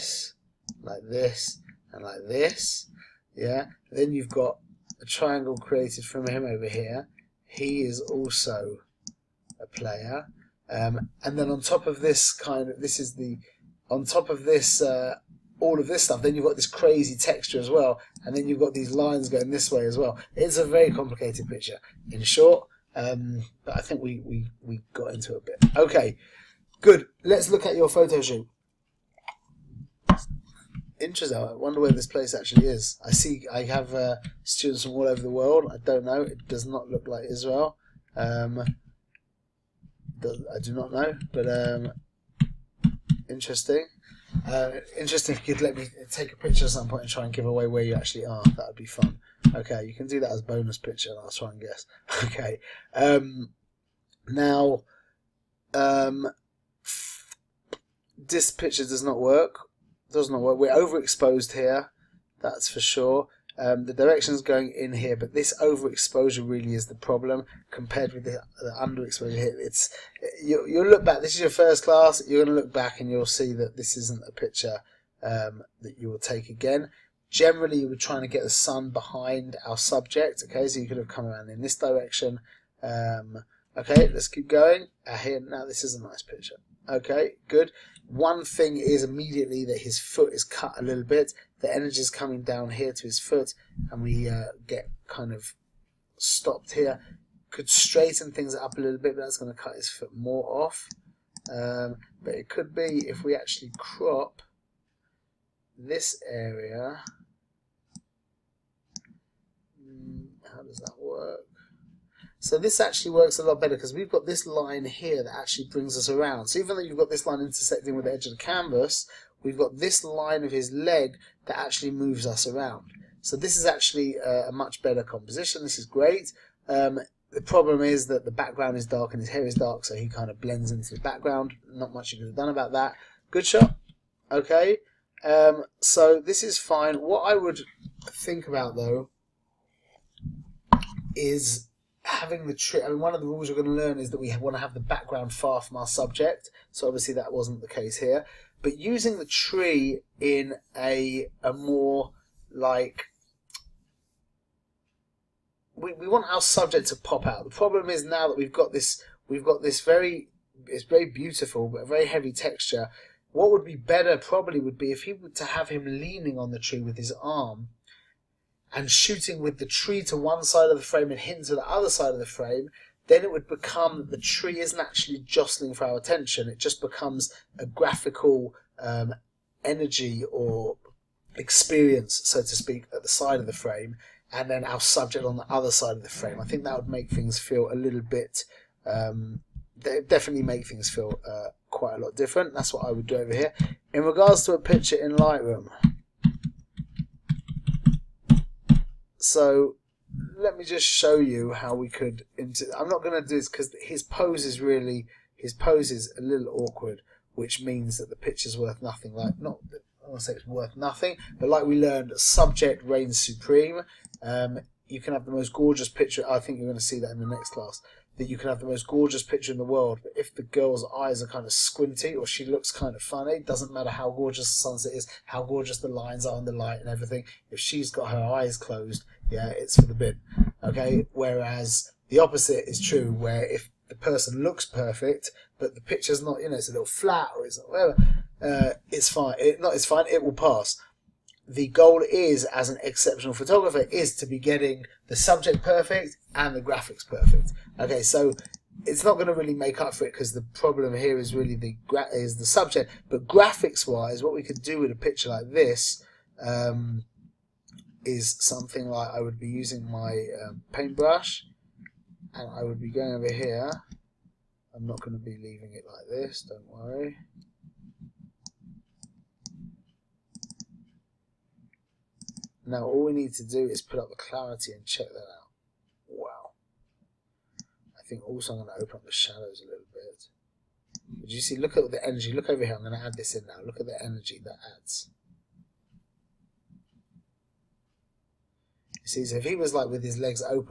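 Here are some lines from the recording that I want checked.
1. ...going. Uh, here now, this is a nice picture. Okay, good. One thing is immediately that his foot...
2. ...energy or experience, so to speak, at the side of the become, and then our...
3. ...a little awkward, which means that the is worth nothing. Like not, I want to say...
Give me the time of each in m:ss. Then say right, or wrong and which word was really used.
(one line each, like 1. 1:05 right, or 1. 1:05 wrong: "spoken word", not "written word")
1. 1:24 right
2. 2:59 wrong: "frame", not "become"
3. 3:26 right.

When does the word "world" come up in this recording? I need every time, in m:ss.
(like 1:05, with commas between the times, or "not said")
0:35, 3:39.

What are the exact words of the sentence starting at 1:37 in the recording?
Could straighten things up a little bit, but that's going to cut his foot more off.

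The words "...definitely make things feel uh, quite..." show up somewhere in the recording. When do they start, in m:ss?
3:09.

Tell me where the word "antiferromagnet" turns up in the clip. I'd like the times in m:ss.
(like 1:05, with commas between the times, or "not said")
not said.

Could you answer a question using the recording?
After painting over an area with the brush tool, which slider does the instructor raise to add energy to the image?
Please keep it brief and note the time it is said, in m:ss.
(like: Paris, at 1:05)
Clarity, at 4:34.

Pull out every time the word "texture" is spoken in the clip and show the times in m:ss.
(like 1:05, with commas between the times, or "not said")
0:17, 2:42.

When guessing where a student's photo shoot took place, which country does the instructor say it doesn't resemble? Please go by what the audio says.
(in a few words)
Israel.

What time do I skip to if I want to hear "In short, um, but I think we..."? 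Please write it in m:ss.
0:22.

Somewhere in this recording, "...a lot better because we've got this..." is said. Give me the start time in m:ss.
1:53.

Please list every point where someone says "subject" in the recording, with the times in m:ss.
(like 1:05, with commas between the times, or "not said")
1:19, 2:25, 2:36, 3:04, 3:32, 4:05, 4:12.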